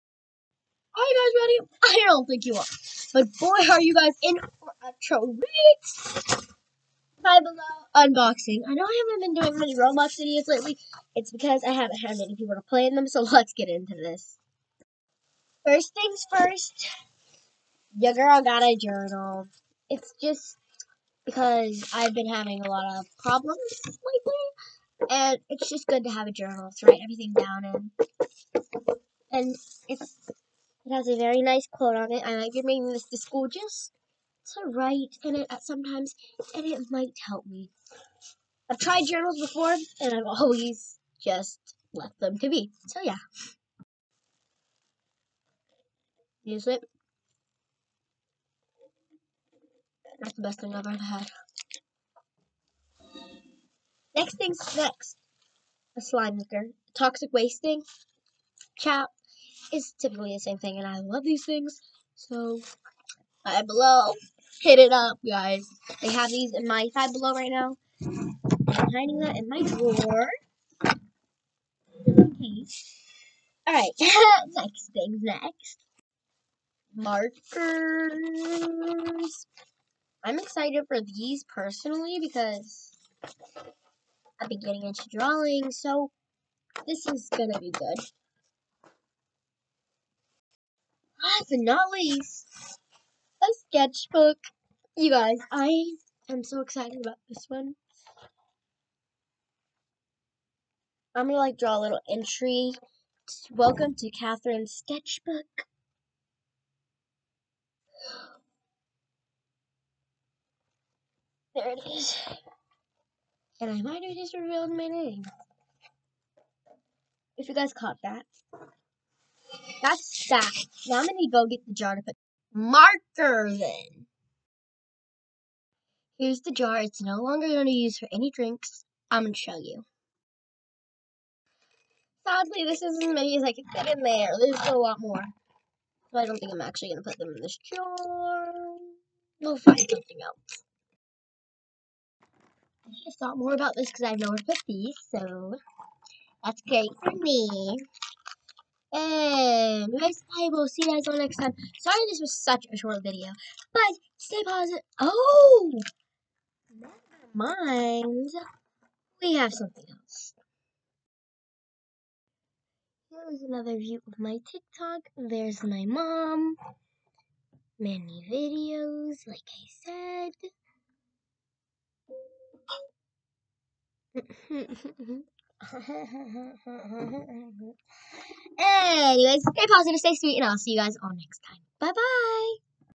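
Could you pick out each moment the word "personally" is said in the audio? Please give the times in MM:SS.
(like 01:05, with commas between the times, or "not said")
01:21.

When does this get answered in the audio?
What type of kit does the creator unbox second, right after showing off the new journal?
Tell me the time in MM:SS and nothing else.
00:55.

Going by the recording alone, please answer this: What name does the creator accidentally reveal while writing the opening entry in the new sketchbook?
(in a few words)
Catherine.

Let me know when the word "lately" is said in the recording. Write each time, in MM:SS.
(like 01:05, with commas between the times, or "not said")
00:10, 00:23.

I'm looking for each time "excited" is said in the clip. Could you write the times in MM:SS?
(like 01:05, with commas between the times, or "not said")
01:20, 01:36.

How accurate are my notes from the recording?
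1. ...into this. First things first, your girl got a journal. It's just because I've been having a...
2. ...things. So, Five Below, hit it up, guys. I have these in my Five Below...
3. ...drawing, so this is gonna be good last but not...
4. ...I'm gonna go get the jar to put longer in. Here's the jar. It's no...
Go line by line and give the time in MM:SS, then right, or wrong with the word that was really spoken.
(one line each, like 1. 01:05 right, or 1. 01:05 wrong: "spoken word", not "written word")
1. 00:13 right
2. 01:01 right
3. 01:25 right
4. 02:00 wrong: "marker", not "longer".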